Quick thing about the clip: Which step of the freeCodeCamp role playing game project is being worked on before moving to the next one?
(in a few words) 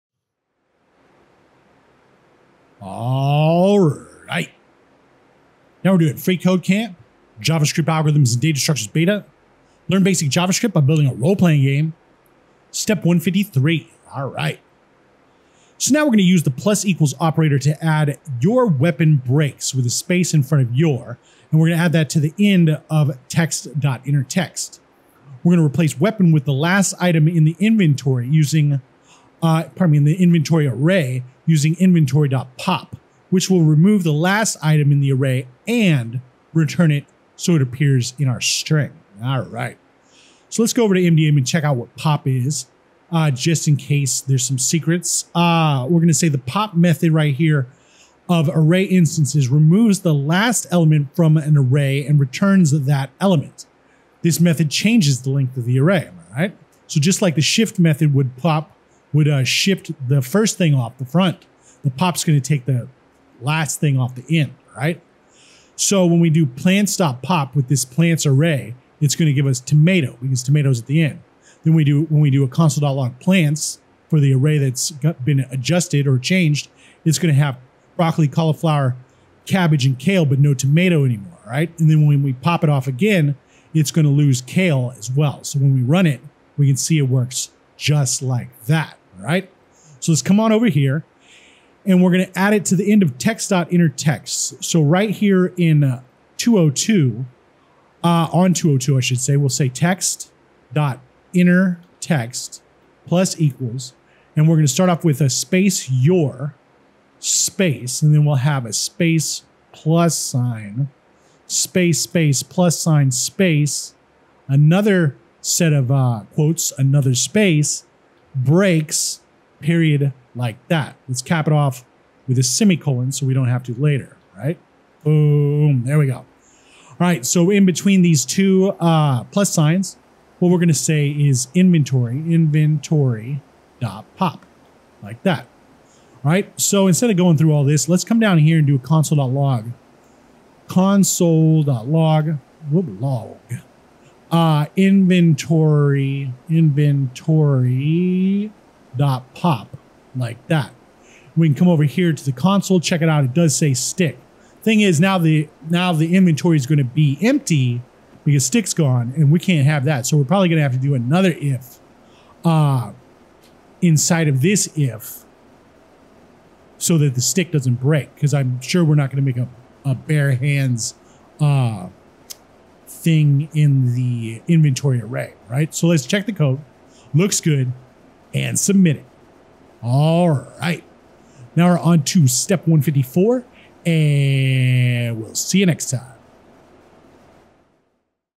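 153.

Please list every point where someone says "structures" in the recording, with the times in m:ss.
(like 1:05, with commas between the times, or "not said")
0:08.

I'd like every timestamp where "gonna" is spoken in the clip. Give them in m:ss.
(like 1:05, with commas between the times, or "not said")
2:10.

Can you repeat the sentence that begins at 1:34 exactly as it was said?
So right here in uh, 202, uh, on 202, I should say, we'll say text.innerText plus equals.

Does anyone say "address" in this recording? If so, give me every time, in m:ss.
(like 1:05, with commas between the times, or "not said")
not said.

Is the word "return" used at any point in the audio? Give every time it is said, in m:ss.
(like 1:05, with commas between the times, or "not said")
0:36, 0:52.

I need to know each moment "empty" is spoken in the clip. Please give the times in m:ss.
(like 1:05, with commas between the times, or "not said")
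2:37.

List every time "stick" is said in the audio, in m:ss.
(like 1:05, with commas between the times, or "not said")
2:33, 2:38, 2:47.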